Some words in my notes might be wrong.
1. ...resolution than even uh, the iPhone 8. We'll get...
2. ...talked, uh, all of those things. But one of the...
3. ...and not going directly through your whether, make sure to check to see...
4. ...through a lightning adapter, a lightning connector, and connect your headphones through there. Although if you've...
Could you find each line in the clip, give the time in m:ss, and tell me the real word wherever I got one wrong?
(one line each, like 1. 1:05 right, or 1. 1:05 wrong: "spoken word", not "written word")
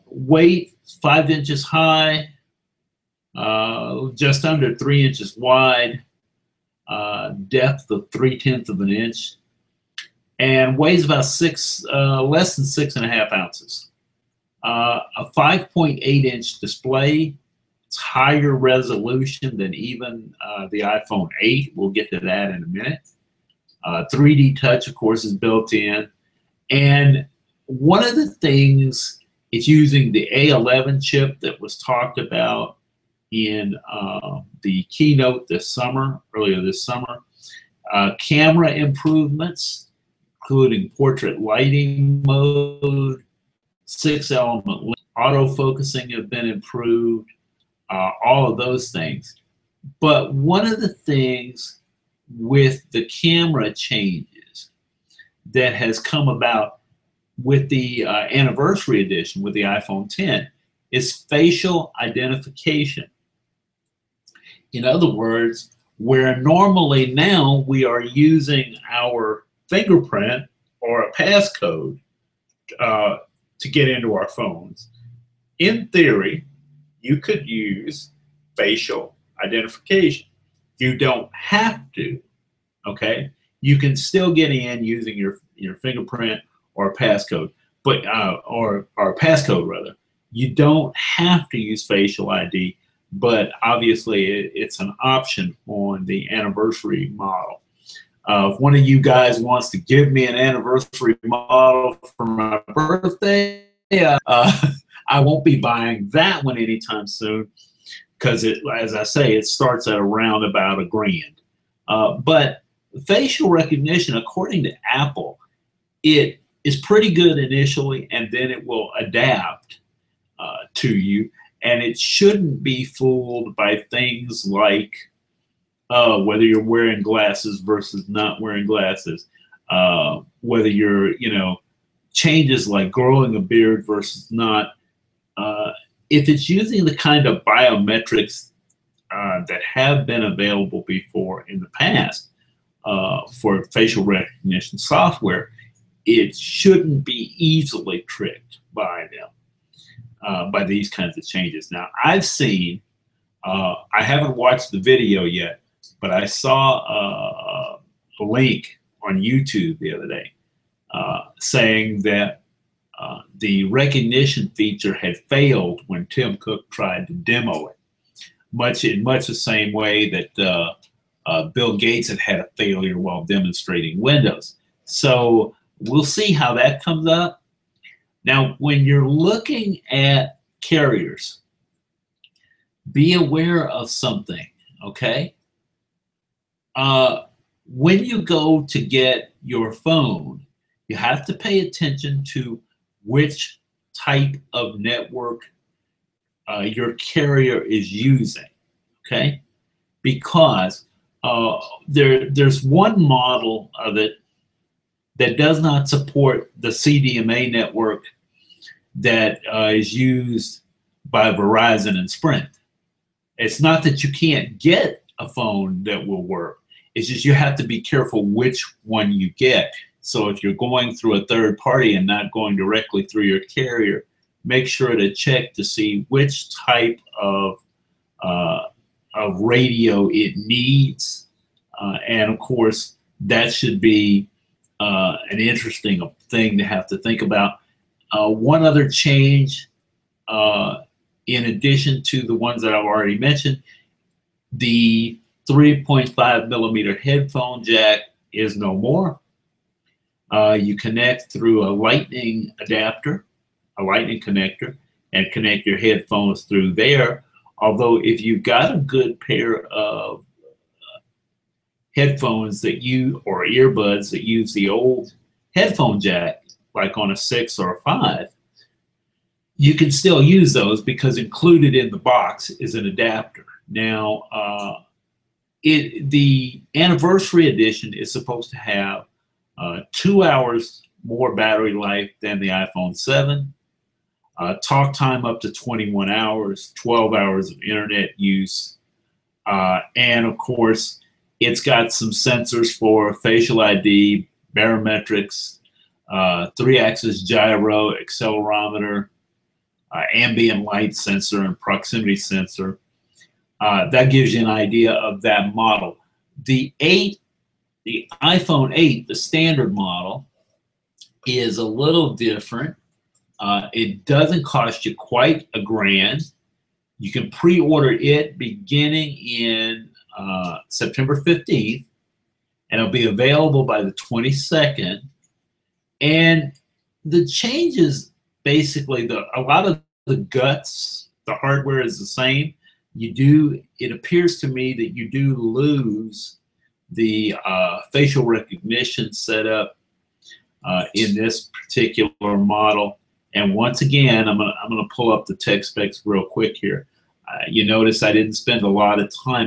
1. 0:18 right
2. 0:46 wrong: "improved", not "talked"
3. 3:41 wrong: "carrier", not "whether"
4. 4:11 right.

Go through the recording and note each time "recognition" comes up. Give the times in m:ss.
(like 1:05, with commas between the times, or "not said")
1:53, 2:24, 2:43, 5:38.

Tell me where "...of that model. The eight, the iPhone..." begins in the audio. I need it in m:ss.
5:04.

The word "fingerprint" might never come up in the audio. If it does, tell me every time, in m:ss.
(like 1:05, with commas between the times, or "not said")
1:09, 1:25.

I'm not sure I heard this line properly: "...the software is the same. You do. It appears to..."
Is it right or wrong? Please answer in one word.
wrong.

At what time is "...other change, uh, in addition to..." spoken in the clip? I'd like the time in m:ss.
3:58.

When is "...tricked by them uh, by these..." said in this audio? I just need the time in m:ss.
2:28.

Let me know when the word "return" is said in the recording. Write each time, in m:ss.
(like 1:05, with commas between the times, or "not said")
not said.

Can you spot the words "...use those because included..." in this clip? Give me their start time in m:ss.
4:30.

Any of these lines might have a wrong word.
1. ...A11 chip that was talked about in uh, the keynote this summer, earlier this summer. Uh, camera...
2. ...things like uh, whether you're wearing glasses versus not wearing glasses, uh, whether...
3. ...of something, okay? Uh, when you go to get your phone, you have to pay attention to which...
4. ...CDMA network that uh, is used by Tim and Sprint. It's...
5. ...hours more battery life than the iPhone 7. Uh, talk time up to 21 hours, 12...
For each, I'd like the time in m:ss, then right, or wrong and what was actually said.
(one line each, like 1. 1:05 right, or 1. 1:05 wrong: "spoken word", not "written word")
1. 0:30 right
2. 2:03 right
3. 3:03 right
4. 3:26 wrong: "Verizon", not "Tim"
5. 4:40 right.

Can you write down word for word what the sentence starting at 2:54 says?
So we'll see how that comes up.